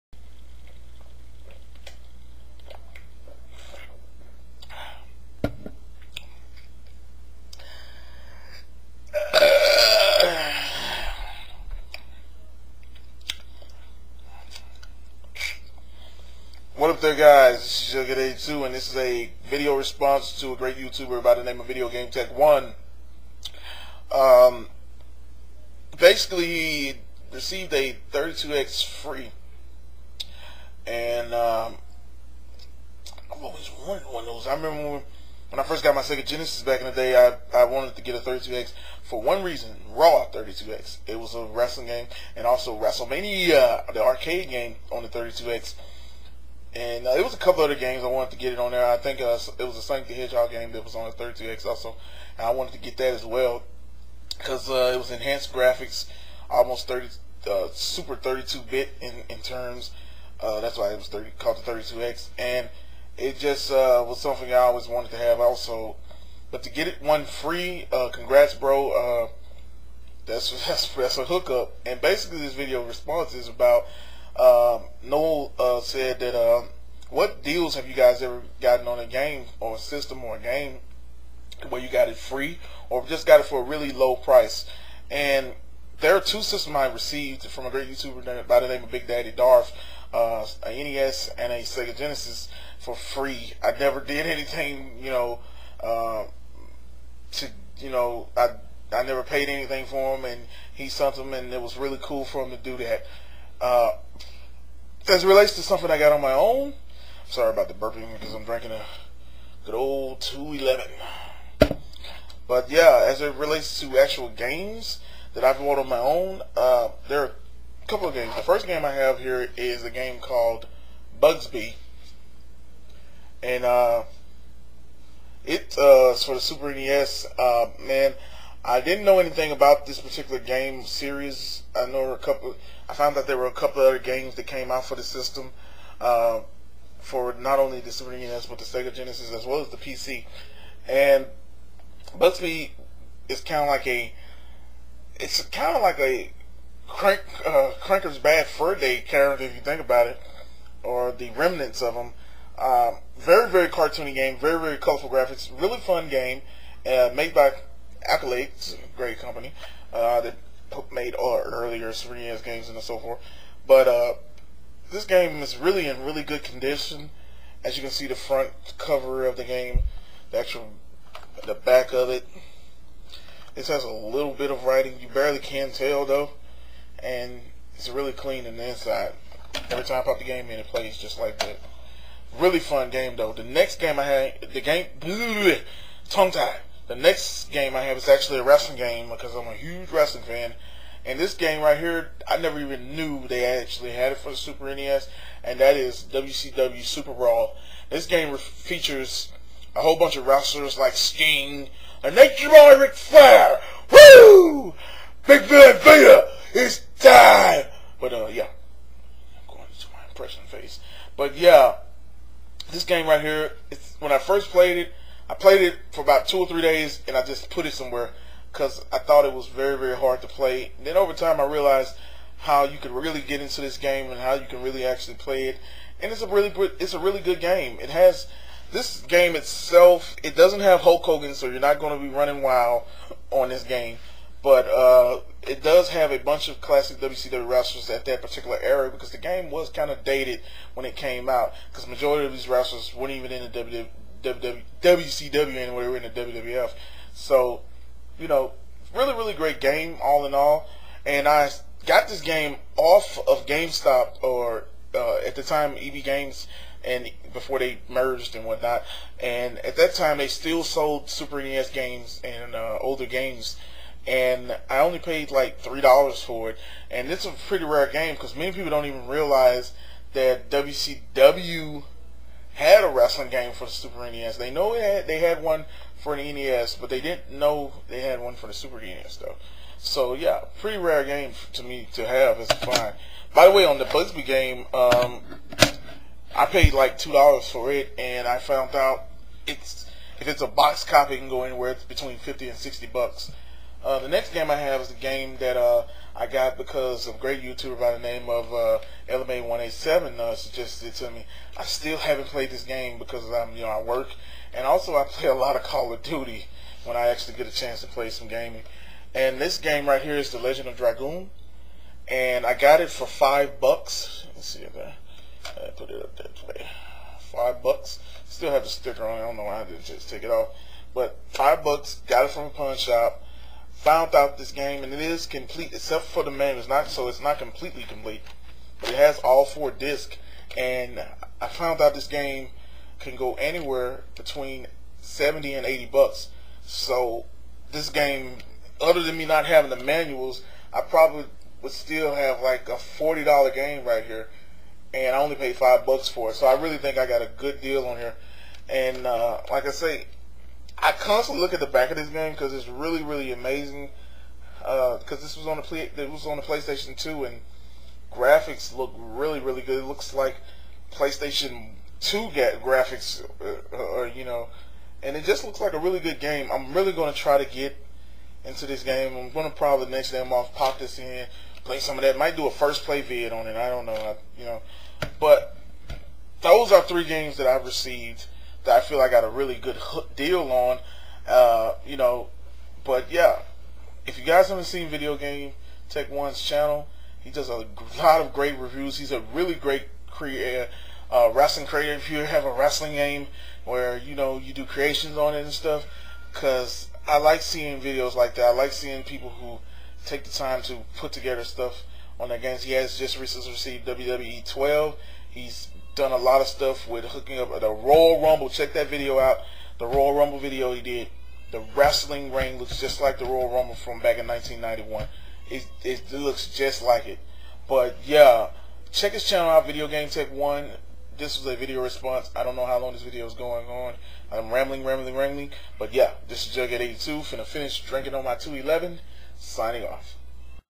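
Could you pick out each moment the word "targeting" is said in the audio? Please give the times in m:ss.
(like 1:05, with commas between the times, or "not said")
not said.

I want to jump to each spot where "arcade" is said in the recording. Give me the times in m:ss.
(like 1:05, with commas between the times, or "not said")
0:44.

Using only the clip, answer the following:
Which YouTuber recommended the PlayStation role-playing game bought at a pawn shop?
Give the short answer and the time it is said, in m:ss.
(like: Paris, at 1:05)
LMA187, at 4:59.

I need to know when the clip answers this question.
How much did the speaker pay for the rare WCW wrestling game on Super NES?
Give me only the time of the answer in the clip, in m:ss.
4:25.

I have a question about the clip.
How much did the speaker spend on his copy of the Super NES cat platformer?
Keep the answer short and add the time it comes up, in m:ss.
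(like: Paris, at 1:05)
2 dollars, at 4:46.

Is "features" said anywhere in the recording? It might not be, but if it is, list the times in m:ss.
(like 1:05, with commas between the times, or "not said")
3:18.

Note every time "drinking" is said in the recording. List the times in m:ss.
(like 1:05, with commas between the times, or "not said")
1:48, 7:07.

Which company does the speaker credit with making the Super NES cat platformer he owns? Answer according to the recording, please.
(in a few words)
Accolade.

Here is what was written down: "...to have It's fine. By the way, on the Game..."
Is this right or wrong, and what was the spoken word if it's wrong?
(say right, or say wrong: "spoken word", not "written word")
wrong: "Bubsy", not "Game".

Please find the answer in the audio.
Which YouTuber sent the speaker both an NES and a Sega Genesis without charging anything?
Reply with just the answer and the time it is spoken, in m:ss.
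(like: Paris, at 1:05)
Big Daddy Darth, at 1:28.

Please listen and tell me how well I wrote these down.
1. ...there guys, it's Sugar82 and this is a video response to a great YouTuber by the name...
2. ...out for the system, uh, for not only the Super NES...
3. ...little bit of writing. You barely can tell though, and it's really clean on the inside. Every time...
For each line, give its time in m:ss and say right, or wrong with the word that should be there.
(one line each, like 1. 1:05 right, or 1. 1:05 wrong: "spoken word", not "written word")
1. 0:16 right
2. 2:14 right
3. 2:53 right.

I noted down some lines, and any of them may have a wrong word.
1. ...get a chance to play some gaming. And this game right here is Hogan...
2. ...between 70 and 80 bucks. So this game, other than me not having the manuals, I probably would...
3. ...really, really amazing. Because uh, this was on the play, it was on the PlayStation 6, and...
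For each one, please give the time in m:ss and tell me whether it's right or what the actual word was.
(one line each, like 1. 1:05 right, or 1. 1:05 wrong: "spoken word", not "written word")
1. 5:07 wrong: "The", not "Hogan"
2. 5:34 right
3. 5:52 wrong: "2", not "6".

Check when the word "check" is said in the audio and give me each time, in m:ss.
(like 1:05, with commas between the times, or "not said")
6:48, 6:58.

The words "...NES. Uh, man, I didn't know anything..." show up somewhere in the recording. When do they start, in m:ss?
2:06.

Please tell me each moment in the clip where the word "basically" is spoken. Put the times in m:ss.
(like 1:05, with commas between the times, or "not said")
0:25, 1:11.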